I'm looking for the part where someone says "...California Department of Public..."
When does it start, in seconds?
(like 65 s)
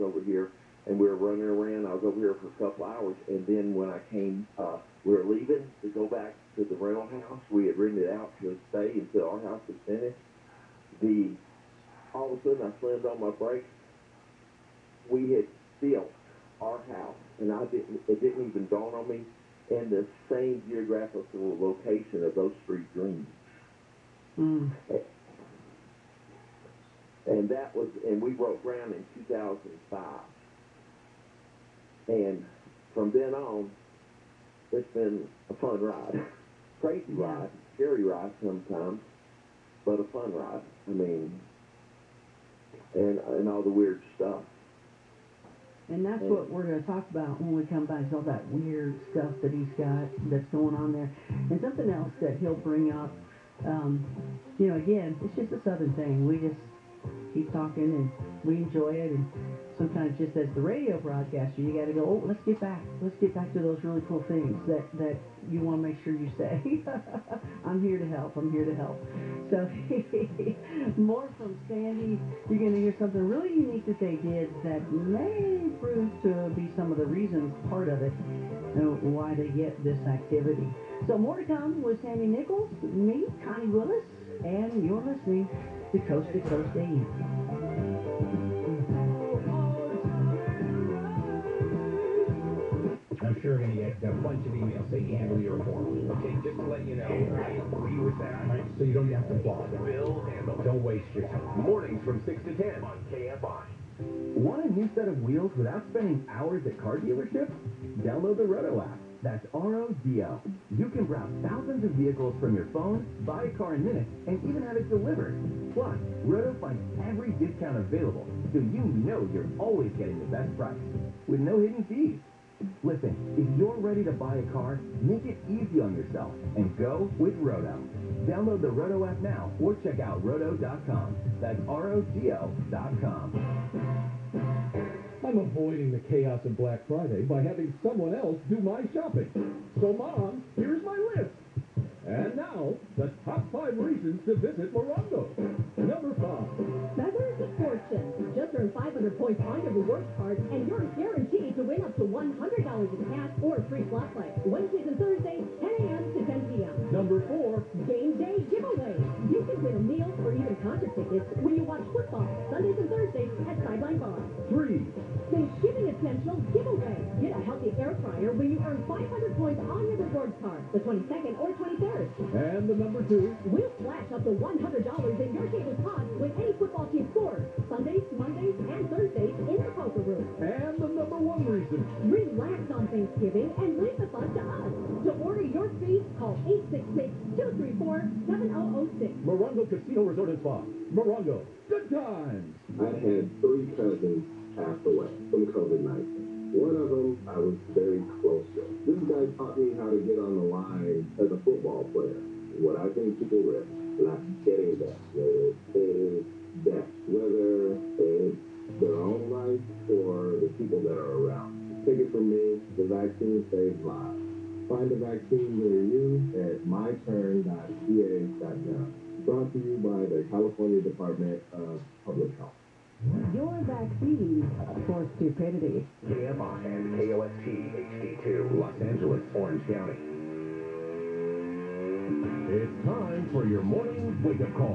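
220 s.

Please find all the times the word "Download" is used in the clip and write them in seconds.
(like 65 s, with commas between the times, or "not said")
108 s, 128 s.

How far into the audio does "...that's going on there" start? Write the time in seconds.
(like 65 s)
50 s.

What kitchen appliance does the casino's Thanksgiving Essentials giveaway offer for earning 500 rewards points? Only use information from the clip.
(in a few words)
Air fryer.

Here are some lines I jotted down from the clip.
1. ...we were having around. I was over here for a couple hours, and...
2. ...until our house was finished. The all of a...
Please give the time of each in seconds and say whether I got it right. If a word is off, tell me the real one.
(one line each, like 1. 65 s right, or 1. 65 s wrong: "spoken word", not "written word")
1. 0 s wrong: "running", not "having"
2. 8 s right.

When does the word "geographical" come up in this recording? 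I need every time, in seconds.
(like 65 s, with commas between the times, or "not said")
20 s.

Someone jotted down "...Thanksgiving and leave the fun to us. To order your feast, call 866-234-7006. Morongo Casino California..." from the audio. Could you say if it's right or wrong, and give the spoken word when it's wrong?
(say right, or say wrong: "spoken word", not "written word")
wrong: "Resort", not "California".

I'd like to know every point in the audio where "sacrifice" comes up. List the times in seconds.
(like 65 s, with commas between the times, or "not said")
not said.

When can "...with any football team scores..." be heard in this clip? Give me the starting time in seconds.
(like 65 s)
176 s.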